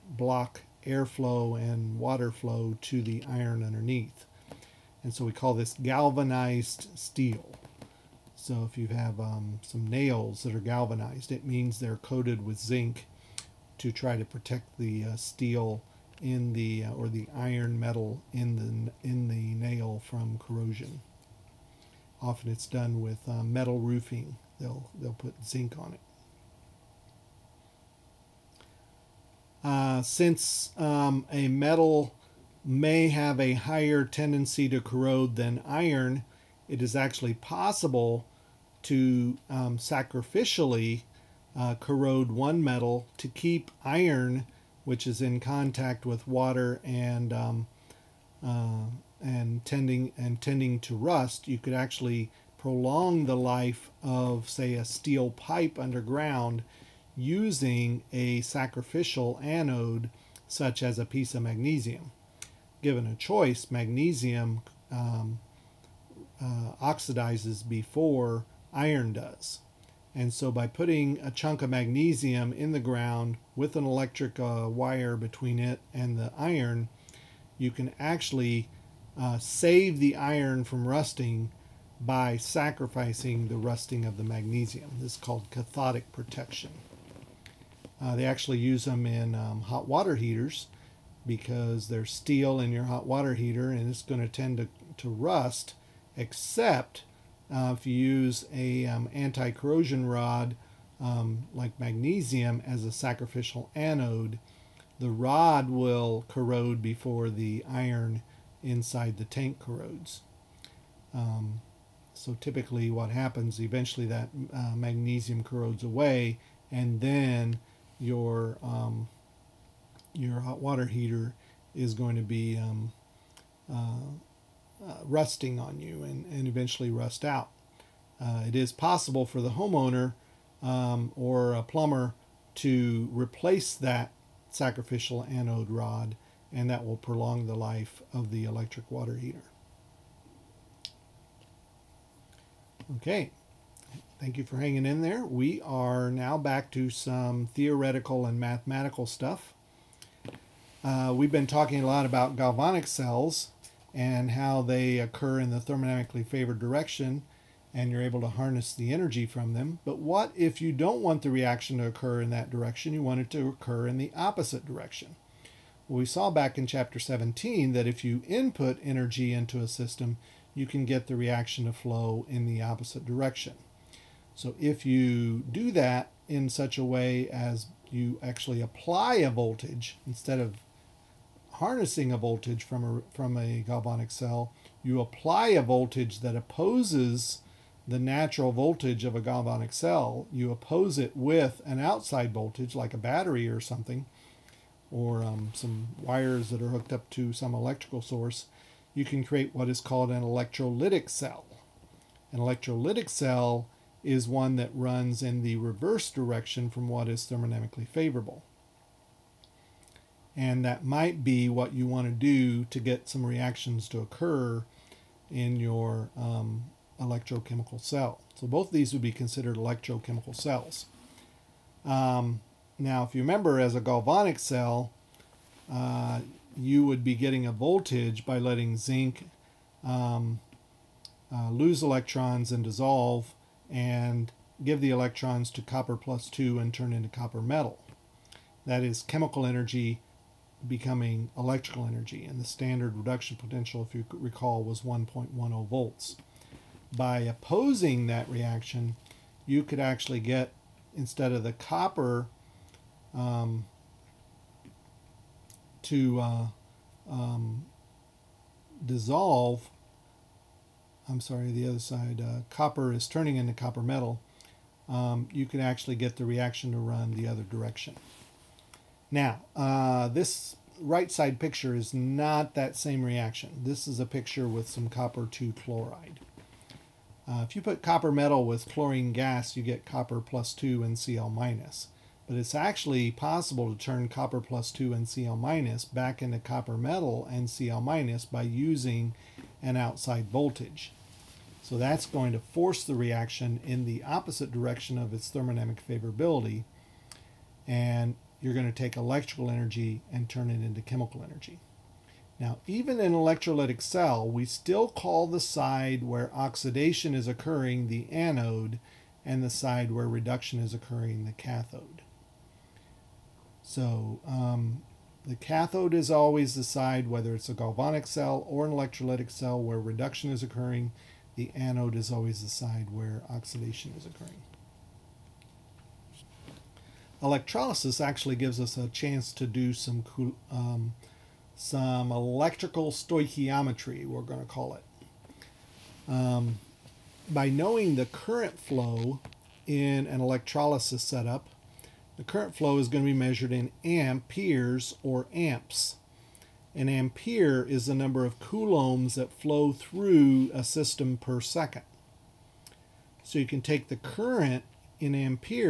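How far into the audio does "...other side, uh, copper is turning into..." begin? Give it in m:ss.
4:21.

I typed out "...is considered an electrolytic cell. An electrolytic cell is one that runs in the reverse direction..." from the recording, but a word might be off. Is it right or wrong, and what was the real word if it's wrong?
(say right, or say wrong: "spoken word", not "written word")
wrong: "called", not "considered".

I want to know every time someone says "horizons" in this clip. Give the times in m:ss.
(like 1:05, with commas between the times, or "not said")
not said.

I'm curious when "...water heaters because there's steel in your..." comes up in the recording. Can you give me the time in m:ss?
1:29.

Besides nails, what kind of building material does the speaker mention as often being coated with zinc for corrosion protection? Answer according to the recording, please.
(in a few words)
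Metal roofing.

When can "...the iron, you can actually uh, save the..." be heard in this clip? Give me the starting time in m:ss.
1:16.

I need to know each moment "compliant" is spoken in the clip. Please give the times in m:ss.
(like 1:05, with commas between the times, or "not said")
not said.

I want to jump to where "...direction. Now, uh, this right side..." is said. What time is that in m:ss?
4:27.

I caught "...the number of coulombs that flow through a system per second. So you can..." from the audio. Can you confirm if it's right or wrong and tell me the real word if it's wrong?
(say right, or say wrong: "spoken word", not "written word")
right.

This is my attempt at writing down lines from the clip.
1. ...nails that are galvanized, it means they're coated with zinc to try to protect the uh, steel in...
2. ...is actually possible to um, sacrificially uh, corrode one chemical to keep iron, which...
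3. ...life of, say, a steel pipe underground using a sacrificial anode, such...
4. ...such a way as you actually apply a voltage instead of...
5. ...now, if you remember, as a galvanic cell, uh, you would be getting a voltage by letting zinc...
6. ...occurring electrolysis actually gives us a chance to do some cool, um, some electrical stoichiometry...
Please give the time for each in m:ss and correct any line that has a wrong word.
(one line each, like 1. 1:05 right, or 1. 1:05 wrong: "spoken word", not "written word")
1. 0:09 right
2. 0:36 wrong: "metal", not "chemical"
3. 0:53 right
4. 2:56 right
5. 3:42 right
6. 5:24 right.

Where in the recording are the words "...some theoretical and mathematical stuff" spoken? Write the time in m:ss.
2:26.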